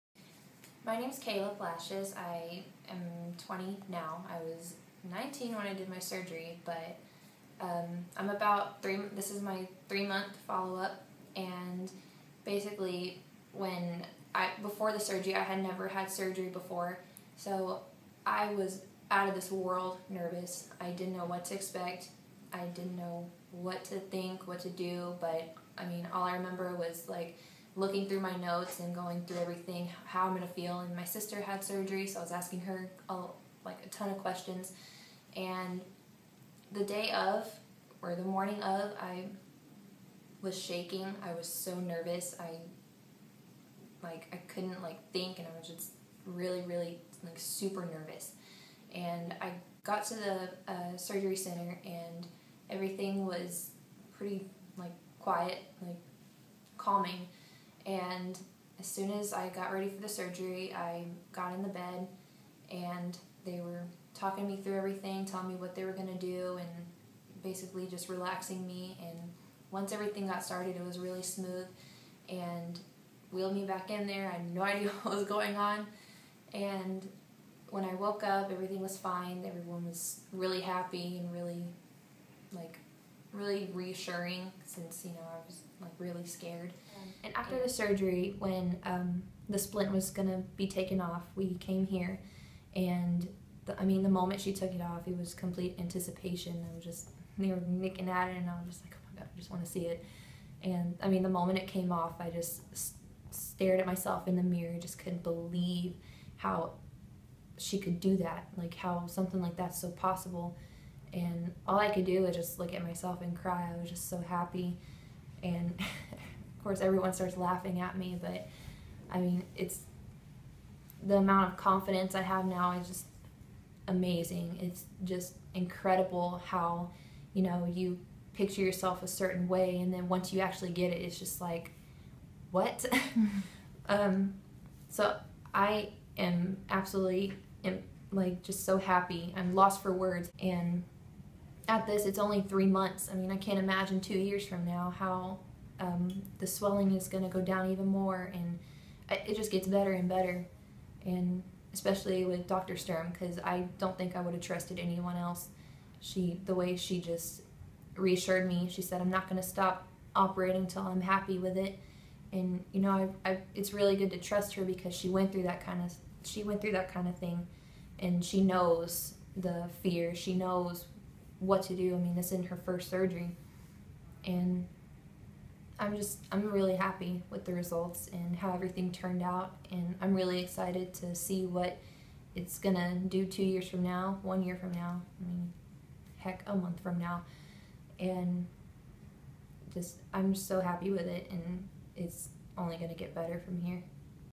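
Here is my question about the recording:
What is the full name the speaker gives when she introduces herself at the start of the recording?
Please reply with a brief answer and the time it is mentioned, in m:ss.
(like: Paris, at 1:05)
Kayla Lashes, at 0:01.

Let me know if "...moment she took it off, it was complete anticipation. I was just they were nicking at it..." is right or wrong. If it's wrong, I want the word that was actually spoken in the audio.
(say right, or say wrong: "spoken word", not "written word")
right.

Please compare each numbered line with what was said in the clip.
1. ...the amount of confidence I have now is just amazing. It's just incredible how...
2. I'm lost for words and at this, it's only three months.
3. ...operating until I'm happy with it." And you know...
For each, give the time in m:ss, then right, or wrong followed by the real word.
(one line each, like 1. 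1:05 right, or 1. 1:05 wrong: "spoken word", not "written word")
1. 2:01 right
2. 2:19 right
3. 2:40 right.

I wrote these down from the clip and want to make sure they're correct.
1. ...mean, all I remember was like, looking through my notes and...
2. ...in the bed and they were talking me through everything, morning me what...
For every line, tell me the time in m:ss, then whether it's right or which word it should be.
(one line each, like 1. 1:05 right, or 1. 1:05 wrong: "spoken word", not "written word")
1. 0:25 right
2. 1:01 wrong: "telling", not "morning".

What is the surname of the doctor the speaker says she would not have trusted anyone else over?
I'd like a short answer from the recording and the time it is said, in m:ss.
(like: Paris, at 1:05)
Sturm, at 2:32.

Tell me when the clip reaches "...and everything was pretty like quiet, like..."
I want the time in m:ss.
0:51.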